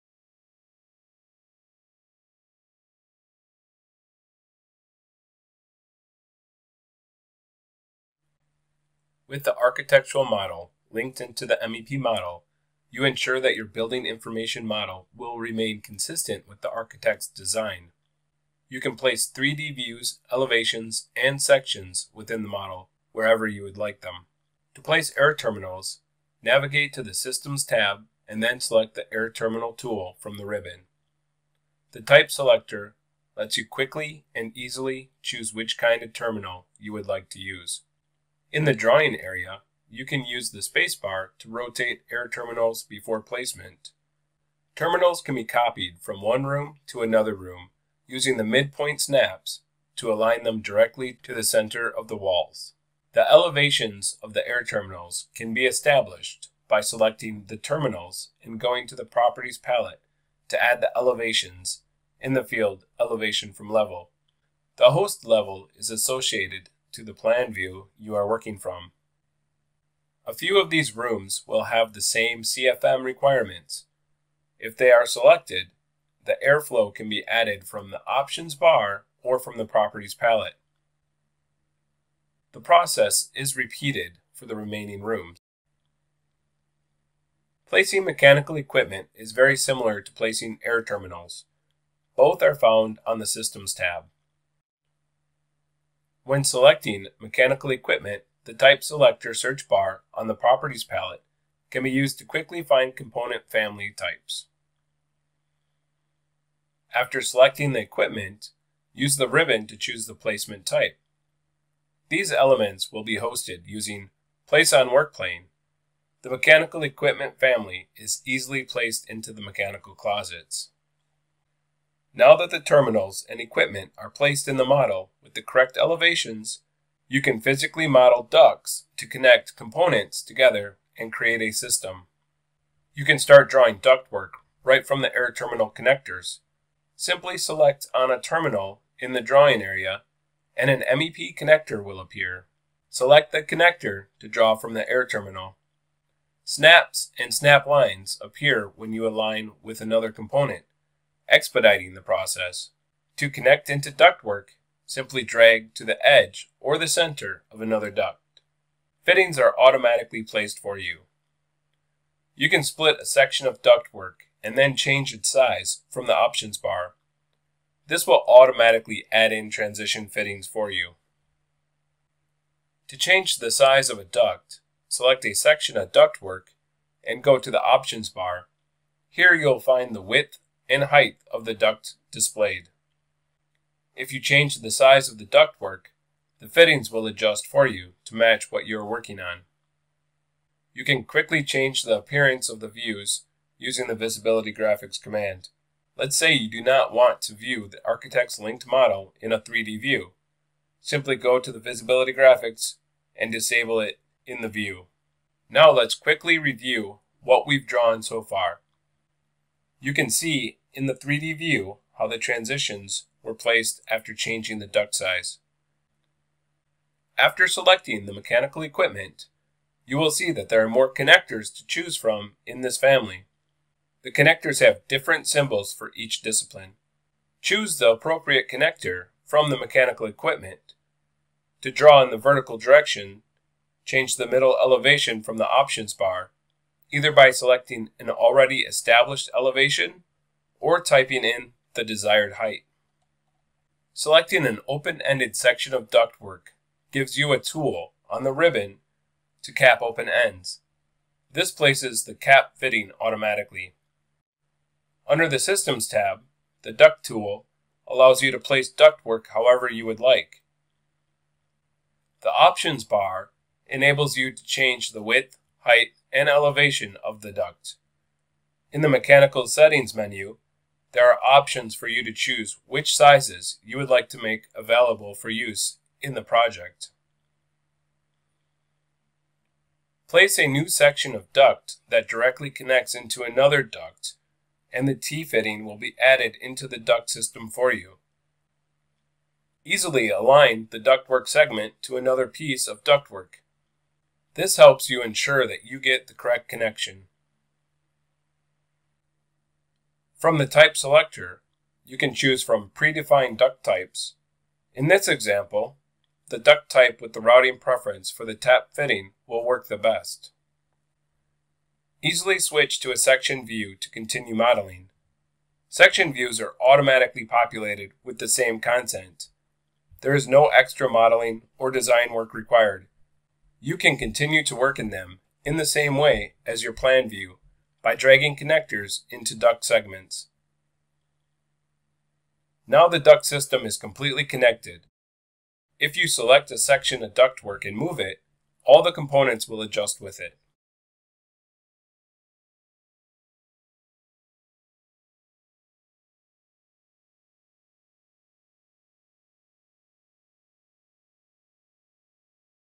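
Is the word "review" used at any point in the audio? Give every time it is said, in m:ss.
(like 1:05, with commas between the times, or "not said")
3:26.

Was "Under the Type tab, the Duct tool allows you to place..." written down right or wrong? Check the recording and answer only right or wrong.
wrong.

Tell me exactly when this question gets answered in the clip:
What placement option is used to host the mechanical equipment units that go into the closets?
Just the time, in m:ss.
1:54.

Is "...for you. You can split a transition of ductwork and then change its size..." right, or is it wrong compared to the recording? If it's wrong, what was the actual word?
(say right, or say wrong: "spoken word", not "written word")
wrong: "section", not "transition".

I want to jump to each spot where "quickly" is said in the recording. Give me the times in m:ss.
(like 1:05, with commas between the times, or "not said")
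0:33, 1:42, 3:11, 3:25.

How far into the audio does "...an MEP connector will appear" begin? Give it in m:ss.
2:20.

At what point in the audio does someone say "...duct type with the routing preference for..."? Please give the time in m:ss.
5:06.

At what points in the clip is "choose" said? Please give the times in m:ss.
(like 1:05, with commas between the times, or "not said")
0:35, 1:49, 3:41, 3:47, 4:32, 5:02.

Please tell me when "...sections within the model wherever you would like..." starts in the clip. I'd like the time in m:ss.
0:21.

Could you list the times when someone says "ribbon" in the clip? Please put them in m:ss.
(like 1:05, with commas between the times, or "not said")
0:30, 1:49, 4:08.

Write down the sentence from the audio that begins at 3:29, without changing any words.
You can see in the 3D view, how the transitions were placed after changing the duct size.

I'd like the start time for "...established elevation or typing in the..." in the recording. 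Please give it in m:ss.
3:58.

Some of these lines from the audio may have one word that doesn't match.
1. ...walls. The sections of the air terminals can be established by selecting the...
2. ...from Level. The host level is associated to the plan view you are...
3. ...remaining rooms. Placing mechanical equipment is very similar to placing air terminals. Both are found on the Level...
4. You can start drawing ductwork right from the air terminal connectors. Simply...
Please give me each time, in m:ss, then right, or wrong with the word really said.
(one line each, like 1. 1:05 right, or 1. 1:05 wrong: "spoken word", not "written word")
1. 0:52 wrong: "elevations", not "sections"
2. 1:03 right
3. 1:24 wrong: "Systems", not "Level"
4. 2:12 right.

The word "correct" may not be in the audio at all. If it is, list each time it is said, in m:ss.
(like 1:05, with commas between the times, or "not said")
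2:05, 4:56.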